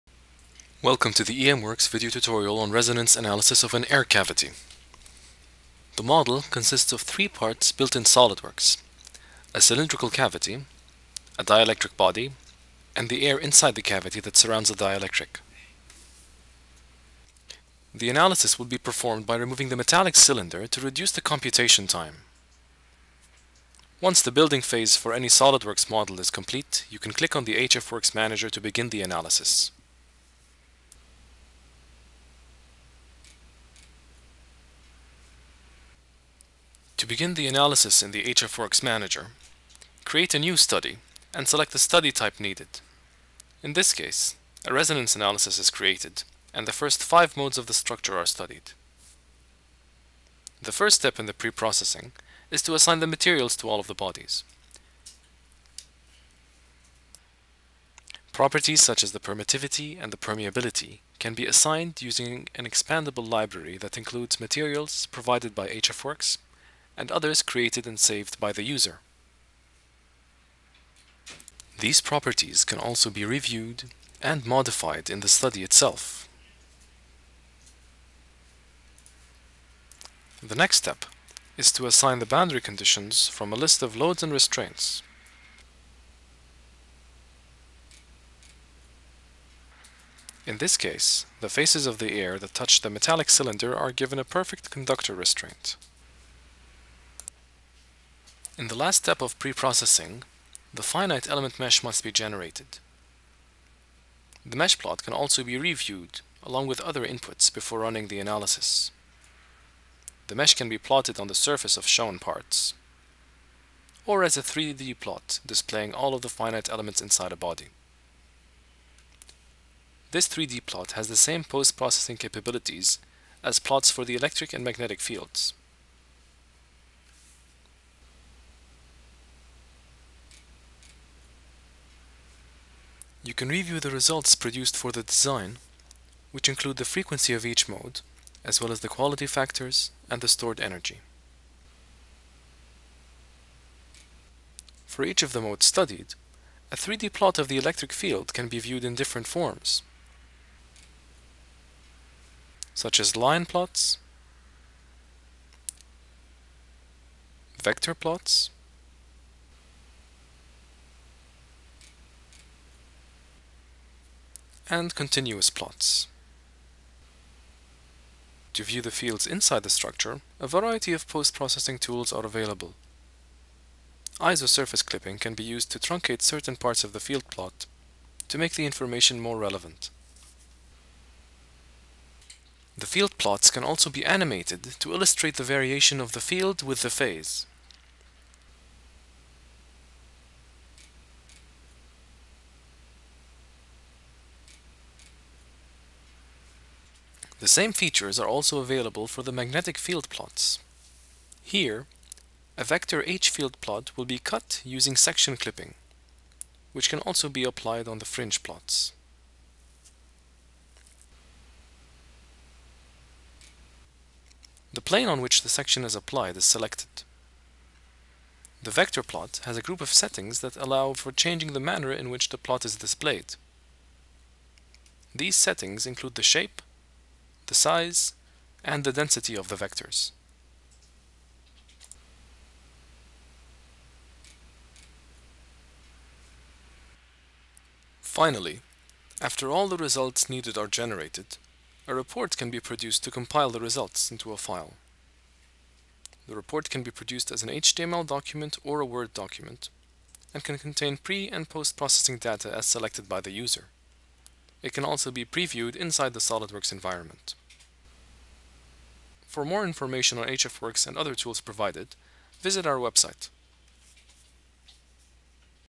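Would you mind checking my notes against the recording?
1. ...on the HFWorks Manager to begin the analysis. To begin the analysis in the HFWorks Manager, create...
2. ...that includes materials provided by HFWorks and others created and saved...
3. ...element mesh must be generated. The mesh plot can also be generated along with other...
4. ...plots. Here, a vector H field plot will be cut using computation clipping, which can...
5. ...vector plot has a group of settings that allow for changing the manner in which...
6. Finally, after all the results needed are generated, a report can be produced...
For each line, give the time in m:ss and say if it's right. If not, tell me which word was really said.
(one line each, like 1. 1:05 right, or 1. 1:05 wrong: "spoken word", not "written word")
1. 0:27 right
2. 1:03 right
3. 1:41 wrong: "reviewed", not "generated"
4. 3:20 wrong: "section", not "computation"
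5. 3:38 right
6. 3:57 right.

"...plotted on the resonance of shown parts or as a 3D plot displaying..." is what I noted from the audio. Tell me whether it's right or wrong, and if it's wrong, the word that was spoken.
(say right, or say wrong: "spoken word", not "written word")
wrong: "surface", not "resonance".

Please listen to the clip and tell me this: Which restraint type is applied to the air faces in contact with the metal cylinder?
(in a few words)
perfect conductor.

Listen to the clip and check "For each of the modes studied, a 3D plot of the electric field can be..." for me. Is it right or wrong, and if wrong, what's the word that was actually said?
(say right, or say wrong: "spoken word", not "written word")
right.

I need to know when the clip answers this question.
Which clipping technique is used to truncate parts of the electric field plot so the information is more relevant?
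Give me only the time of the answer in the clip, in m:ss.
2:54.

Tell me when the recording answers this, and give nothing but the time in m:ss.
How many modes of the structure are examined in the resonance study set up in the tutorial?
0:47.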